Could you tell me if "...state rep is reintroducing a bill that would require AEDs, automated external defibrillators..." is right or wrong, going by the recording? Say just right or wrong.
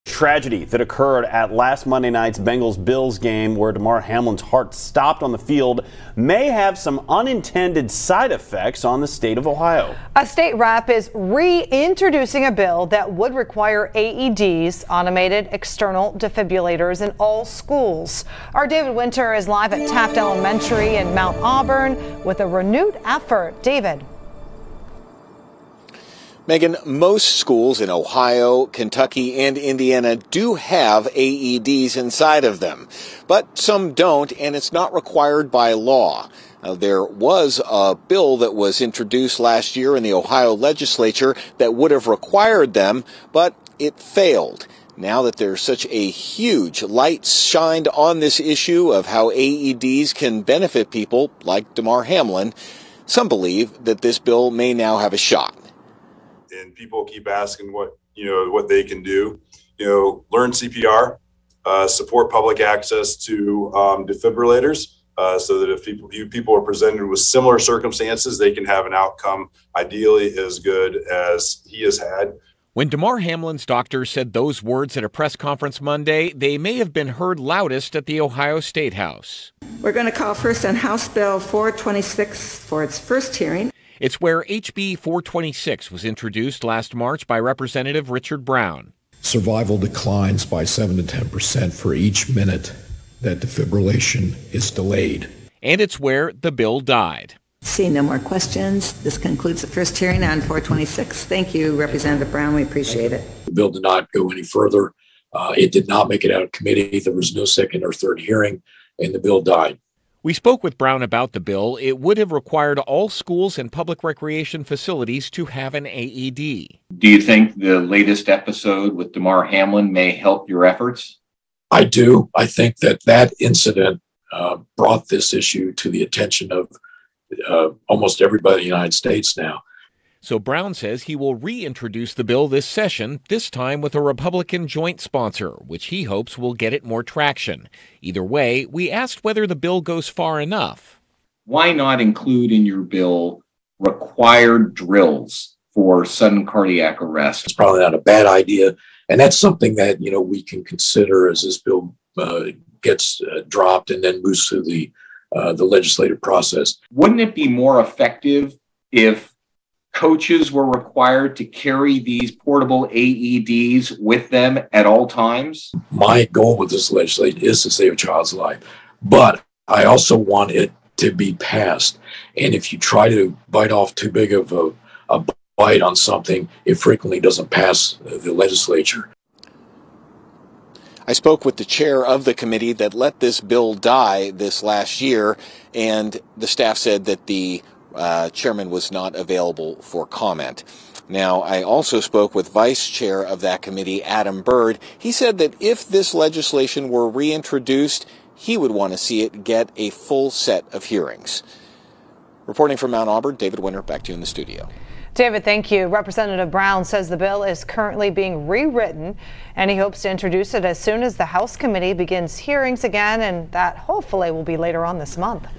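right.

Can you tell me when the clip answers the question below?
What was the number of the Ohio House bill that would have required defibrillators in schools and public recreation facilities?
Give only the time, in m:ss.
1:20.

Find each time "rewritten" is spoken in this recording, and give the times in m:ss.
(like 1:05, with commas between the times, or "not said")
3:28.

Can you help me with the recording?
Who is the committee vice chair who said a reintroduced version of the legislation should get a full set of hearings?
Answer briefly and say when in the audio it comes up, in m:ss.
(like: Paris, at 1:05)
Adam Bird, at 3:14.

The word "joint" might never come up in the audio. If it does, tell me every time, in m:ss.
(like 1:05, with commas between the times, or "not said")
2:14.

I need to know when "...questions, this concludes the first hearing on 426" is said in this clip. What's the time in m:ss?
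1:38.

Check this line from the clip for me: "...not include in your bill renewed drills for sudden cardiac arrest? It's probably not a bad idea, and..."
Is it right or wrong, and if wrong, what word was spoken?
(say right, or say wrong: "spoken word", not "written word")
wrong: "required", not "renewed".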